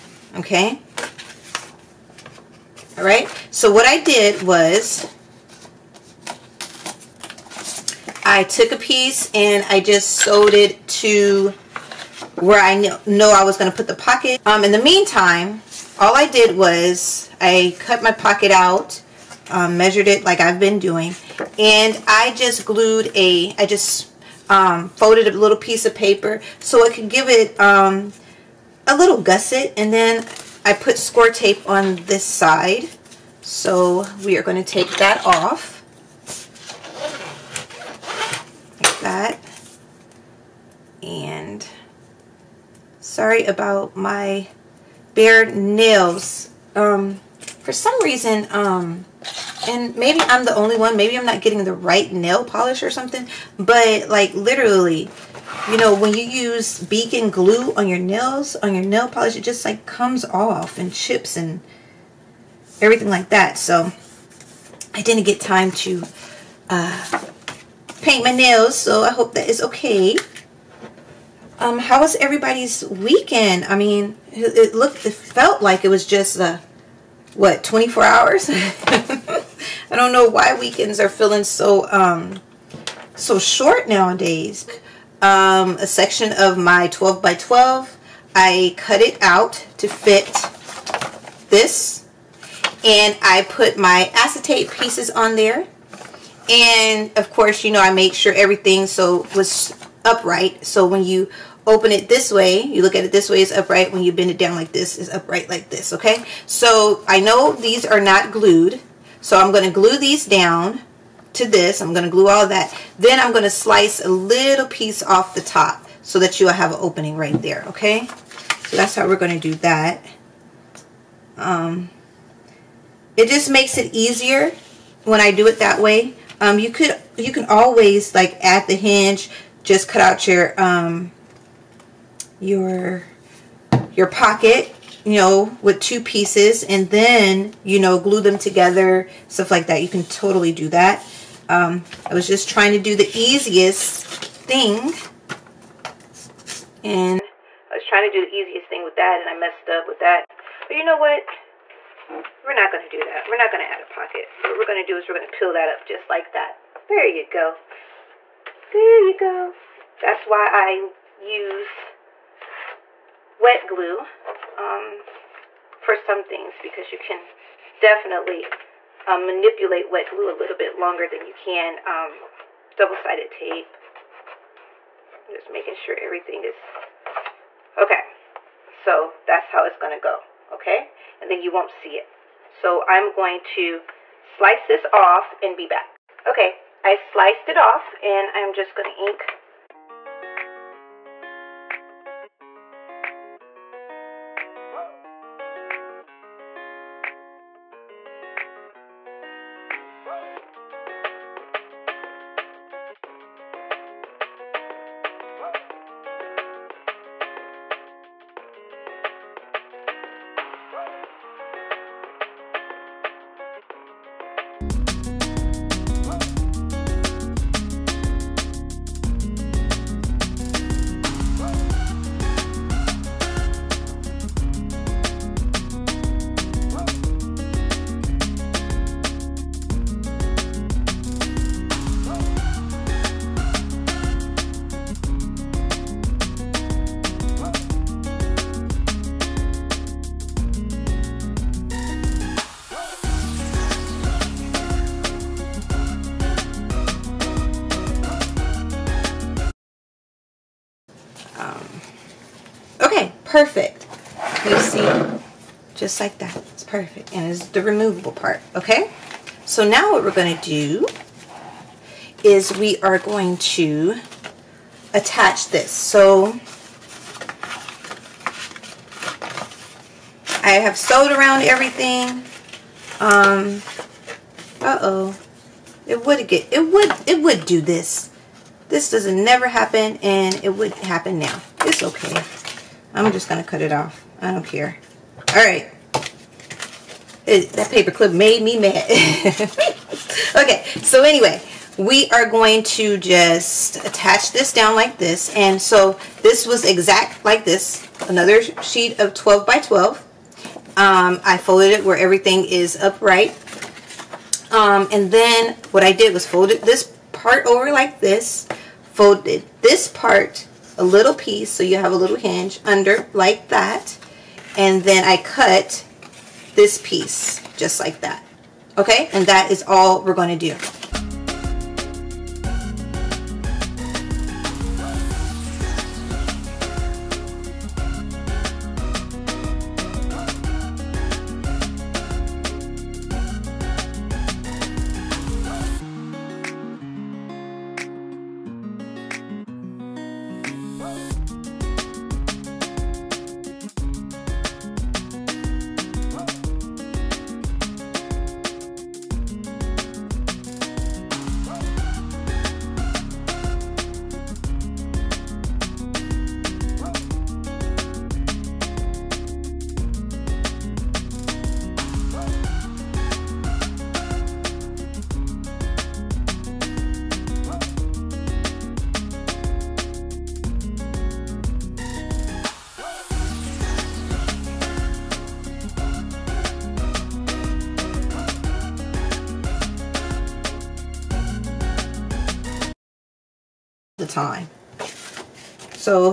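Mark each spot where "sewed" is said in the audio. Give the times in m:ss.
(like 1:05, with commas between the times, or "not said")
0:10, 4:30.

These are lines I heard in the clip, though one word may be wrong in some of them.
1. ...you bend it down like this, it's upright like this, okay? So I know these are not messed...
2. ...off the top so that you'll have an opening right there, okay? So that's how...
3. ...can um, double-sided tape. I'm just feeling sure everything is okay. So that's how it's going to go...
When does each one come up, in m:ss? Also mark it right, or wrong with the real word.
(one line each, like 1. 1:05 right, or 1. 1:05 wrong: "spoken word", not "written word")
1. 1:44 wrong: "glued", not "messed"
2. 1:55 right
3. 2:51 wrong: "making", not "feeling".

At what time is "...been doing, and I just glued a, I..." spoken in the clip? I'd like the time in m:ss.
0:20.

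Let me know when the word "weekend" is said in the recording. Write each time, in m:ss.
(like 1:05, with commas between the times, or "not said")
1:12, 1:20.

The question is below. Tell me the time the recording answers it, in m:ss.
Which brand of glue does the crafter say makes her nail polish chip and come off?
0:56.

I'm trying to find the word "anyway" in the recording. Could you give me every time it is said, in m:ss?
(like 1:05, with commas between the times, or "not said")
4:51.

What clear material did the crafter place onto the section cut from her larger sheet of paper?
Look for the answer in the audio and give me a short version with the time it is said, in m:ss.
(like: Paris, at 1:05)
acetate, at 1:34.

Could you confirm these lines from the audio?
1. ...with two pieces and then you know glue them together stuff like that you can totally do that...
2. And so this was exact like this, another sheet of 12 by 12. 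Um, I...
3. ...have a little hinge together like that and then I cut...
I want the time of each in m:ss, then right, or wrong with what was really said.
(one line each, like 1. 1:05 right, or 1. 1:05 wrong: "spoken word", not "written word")
1. 2:15 right
2. 4:55 right
3. 5:11 wrong: "under", not "together".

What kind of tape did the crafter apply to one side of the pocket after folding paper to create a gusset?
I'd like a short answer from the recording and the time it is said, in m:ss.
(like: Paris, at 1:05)
score tape, at 0:30.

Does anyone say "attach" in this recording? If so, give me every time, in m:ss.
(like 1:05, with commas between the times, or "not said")
4:24, 4:53.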